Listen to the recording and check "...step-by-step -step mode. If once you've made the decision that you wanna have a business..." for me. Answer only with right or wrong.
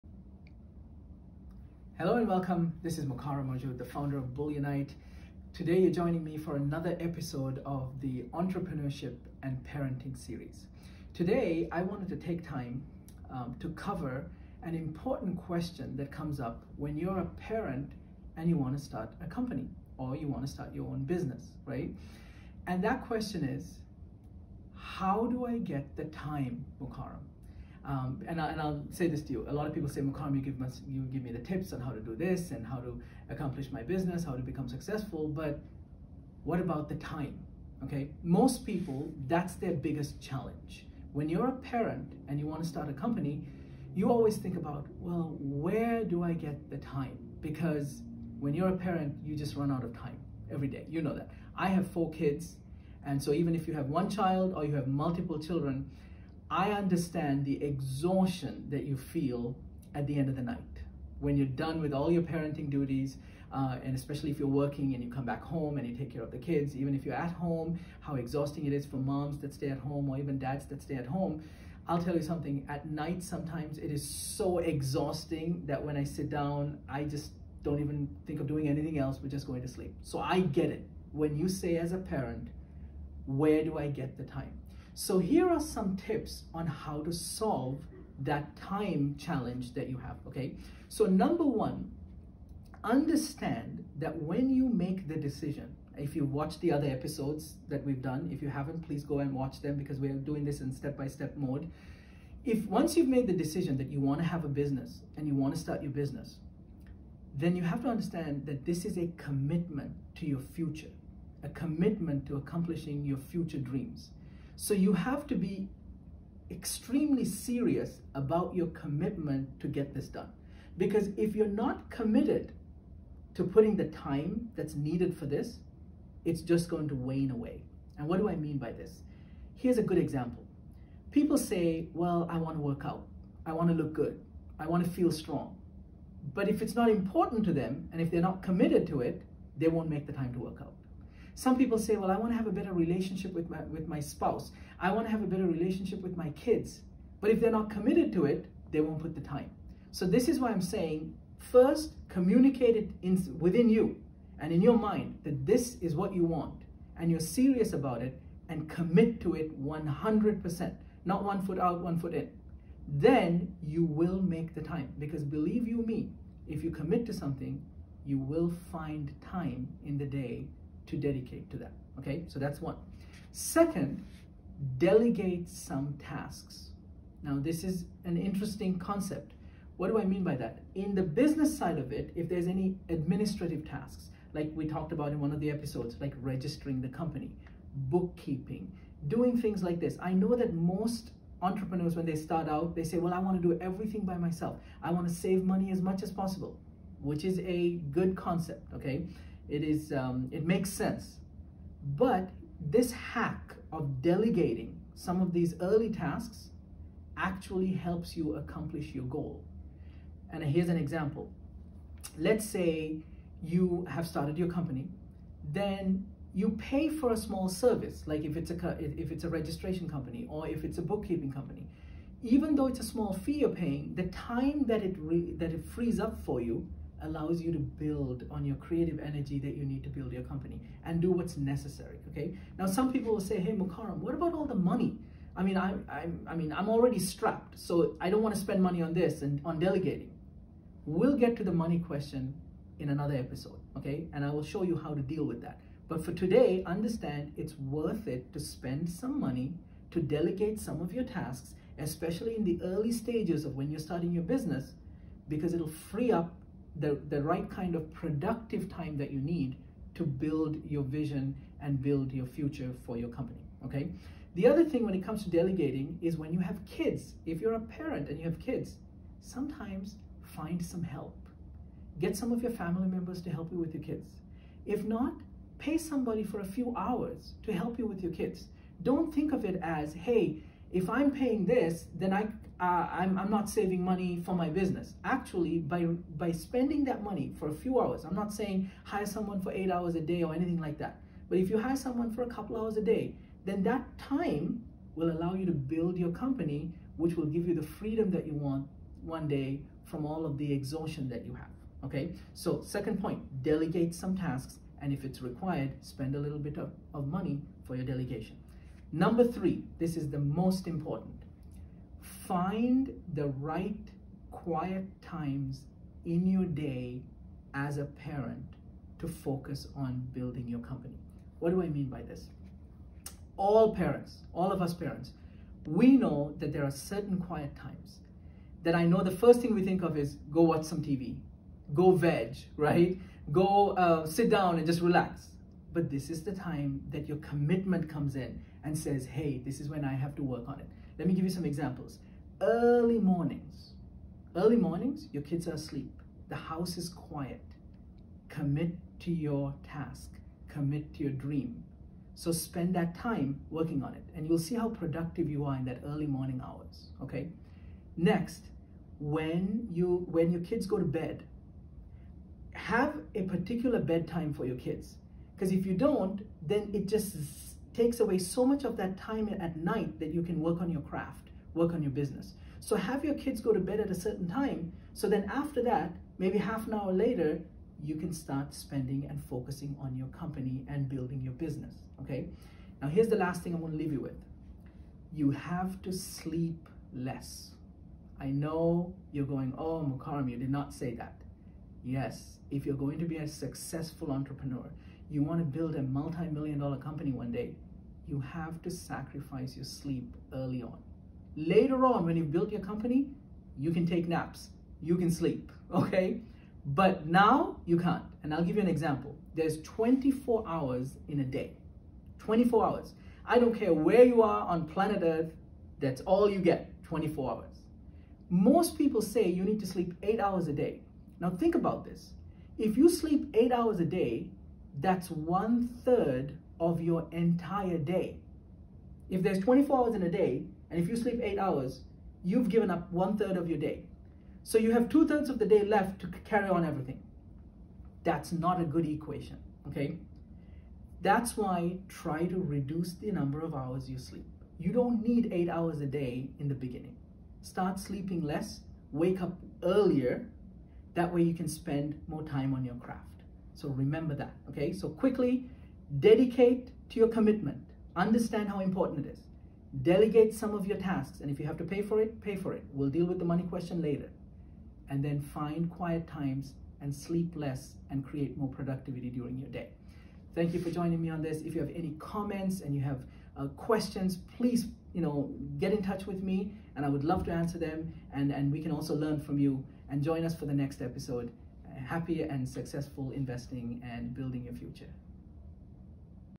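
right.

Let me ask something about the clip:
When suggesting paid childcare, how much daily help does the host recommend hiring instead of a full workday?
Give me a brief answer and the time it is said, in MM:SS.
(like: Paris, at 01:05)
A couple hours, at 04:52.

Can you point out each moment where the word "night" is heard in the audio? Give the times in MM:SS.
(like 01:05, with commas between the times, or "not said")
01:00, 01:12, 06:09.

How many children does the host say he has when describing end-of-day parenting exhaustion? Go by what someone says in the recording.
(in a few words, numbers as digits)
4.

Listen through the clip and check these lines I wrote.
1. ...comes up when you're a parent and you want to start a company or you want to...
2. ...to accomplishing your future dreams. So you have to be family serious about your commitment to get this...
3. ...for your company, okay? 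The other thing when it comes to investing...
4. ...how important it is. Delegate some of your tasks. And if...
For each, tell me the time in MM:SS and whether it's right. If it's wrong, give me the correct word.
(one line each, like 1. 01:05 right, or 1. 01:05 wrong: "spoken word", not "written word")
1. 00:16 right
2. 01:52 wrong: "extremely", not "family"
3. 04:22 wrong: "delegating", not "investing"
4. 07:38 right.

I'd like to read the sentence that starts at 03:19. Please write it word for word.
It is, um, it makes sense.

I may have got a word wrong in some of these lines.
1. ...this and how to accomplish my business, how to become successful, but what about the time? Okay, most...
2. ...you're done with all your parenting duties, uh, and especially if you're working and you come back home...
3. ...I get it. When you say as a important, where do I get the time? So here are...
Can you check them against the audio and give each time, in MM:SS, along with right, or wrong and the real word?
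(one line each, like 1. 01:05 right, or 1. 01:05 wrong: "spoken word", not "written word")
1. 00:32 right
2. 01:01 right
3. 01:20 wrong: "parent", not "important".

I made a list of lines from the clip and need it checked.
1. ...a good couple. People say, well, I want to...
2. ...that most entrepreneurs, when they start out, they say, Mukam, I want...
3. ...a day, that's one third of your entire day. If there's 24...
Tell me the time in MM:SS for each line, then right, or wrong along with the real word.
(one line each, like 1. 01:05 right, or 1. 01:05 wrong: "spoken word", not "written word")
1. 02:09 wrong: "example", not "couple"
2. 03:10 wrong: "Well", not "Mukam"
3. 07:03 right.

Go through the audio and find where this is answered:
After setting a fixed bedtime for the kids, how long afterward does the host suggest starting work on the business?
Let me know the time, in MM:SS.
06:16.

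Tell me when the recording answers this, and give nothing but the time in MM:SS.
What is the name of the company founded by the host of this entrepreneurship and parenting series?
00:04.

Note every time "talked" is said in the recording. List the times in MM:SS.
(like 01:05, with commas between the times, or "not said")
03:04.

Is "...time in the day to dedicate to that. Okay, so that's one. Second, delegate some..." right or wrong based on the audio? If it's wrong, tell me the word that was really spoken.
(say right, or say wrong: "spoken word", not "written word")
right.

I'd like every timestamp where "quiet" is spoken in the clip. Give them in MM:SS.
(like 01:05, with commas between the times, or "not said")
05:14, 05:27, 05:46, 07:45.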